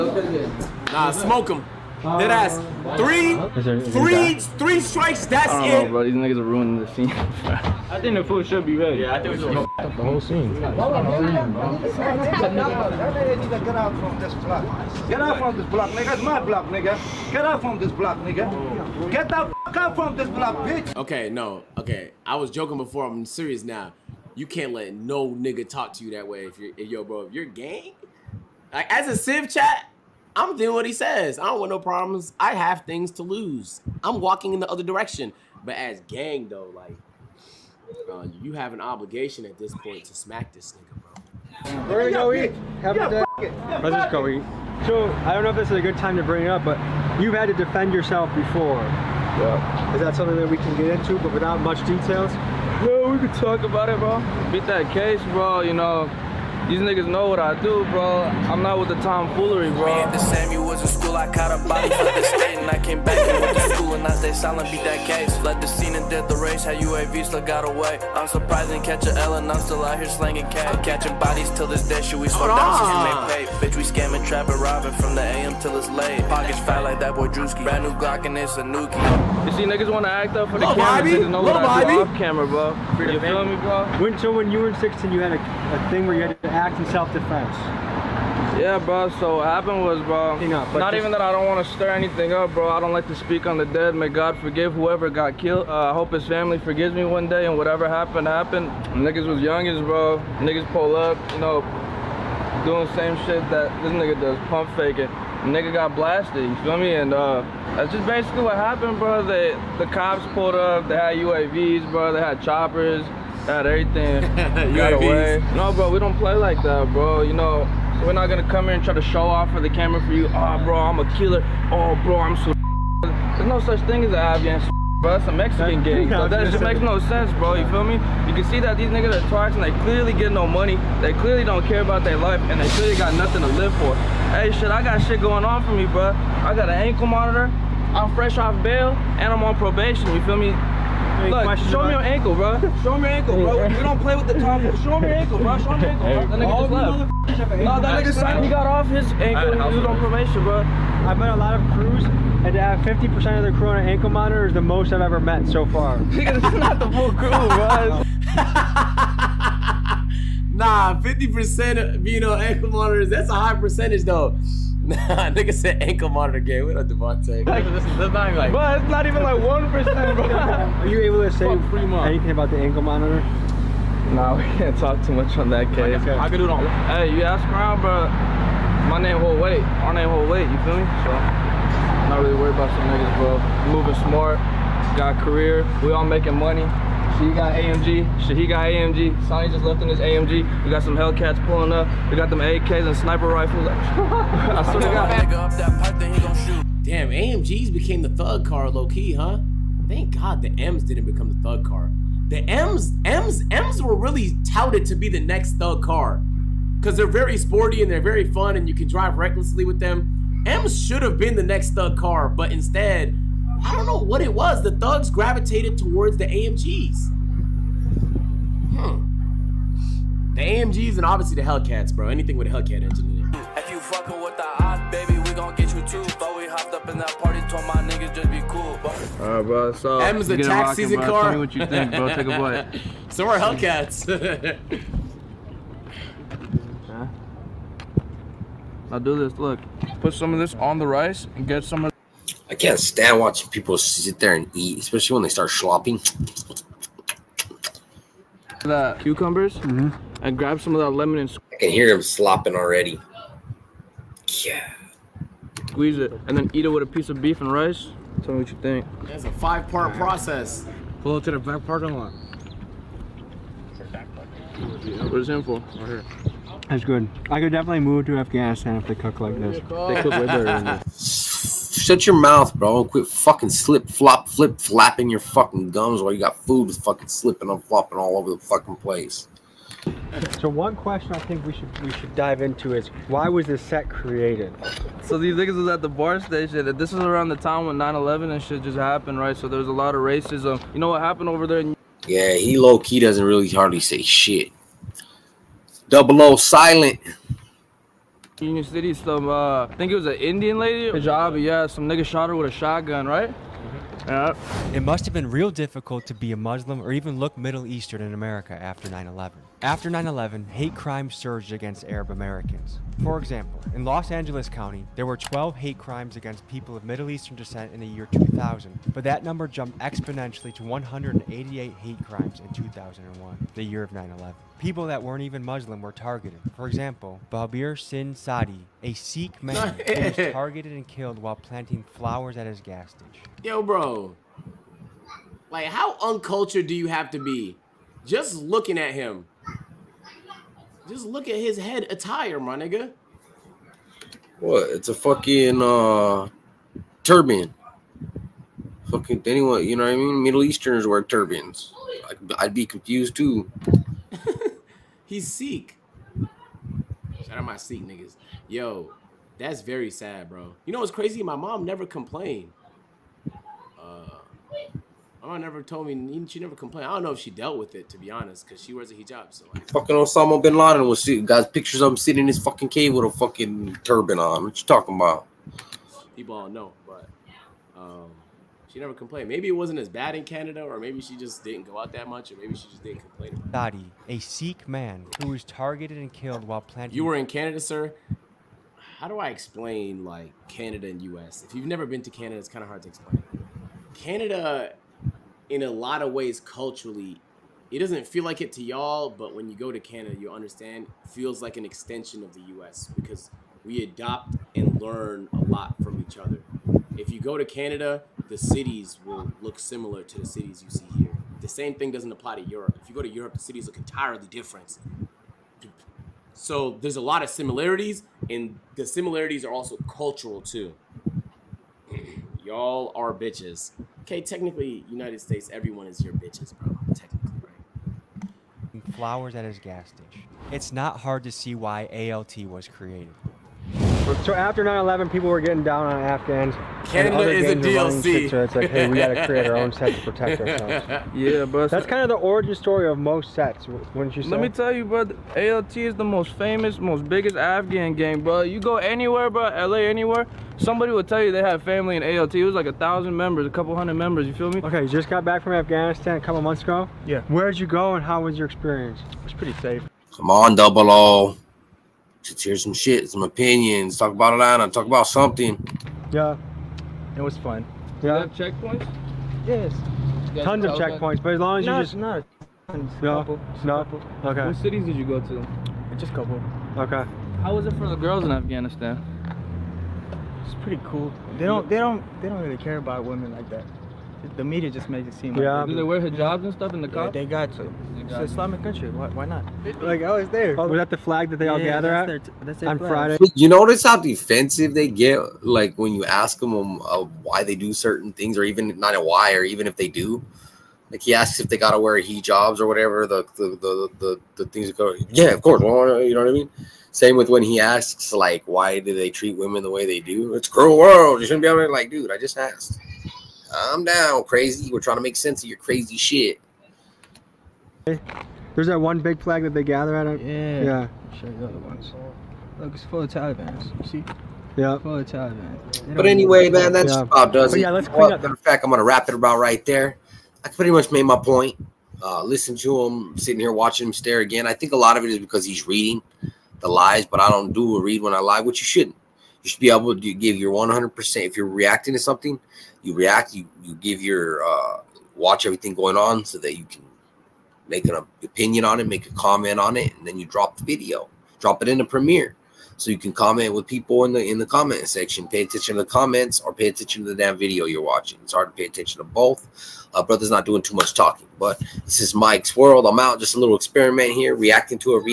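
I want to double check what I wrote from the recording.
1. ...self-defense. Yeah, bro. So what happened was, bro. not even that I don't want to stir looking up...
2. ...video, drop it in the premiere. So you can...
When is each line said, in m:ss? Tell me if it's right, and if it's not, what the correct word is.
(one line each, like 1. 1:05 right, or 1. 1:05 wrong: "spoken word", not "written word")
1. 1:26 wrong: "anything", not "looking"
2. 9:10 right.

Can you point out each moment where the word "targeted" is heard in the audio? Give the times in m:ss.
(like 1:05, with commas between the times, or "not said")
5:25, 5:30, 6:25.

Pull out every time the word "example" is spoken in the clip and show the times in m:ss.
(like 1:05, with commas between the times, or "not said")
5:13, 5:26.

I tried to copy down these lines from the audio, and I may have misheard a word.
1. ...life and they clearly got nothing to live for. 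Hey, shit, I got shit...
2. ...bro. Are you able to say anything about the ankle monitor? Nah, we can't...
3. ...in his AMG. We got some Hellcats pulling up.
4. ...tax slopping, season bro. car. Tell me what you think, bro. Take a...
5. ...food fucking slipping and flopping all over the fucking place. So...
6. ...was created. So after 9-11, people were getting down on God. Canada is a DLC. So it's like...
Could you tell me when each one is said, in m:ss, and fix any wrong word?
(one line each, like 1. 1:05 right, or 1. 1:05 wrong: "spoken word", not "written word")
1. 2:12 right
2. 2:50 right
3. 3:09 right
4. 3:50 wrong: "rocking", not "slopping"
5. 4:36 right
6. 7:12 wrong: "Afghans", not "God".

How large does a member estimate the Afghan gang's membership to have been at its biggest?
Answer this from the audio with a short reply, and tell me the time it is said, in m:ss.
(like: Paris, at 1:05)
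a thousand, at 7:32.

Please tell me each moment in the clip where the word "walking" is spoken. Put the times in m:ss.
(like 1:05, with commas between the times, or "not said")
0:34.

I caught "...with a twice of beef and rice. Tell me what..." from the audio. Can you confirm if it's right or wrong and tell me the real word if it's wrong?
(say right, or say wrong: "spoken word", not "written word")
wrong: "piece", not "twice".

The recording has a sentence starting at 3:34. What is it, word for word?
The thugs gravitated towards the AMGs.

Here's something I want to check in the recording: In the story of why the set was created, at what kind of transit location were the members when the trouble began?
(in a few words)
BART station.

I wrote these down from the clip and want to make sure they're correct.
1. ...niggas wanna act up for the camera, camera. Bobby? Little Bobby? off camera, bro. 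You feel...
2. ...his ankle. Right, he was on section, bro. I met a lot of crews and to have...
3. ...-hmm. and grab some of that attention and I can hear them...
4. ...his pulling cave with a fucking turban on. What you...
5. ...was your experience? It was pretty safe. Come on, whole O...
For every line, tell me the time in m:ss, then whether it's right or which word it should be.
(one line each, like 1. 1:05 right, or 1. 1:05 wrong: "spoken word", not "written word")
1. 1:19 right
2. 2:28 wrong: "probation", not "section"
3. 4:09 wrong: "lemon", not "attention"
4. 6:12 wrong: "fucking", not "pulling"
5. 7:38 wrong: "double", not "whole".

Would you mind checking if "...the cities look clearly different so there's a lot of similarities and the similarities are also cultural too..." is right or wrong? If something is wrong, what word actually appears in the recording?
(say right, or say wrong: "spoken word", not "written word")
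wrong: "entirely", not "clearly".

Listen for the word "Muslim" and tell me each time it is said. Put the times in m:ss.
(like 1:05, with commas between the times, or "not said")
5:06, 5:25.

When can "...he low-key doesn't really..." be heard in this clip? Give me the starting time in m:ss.
4:52.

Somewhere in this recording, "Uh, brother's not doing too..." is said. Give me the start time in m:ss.
9:19.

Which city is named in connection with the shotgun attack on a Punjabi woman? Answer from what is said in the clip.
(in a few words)
Union City.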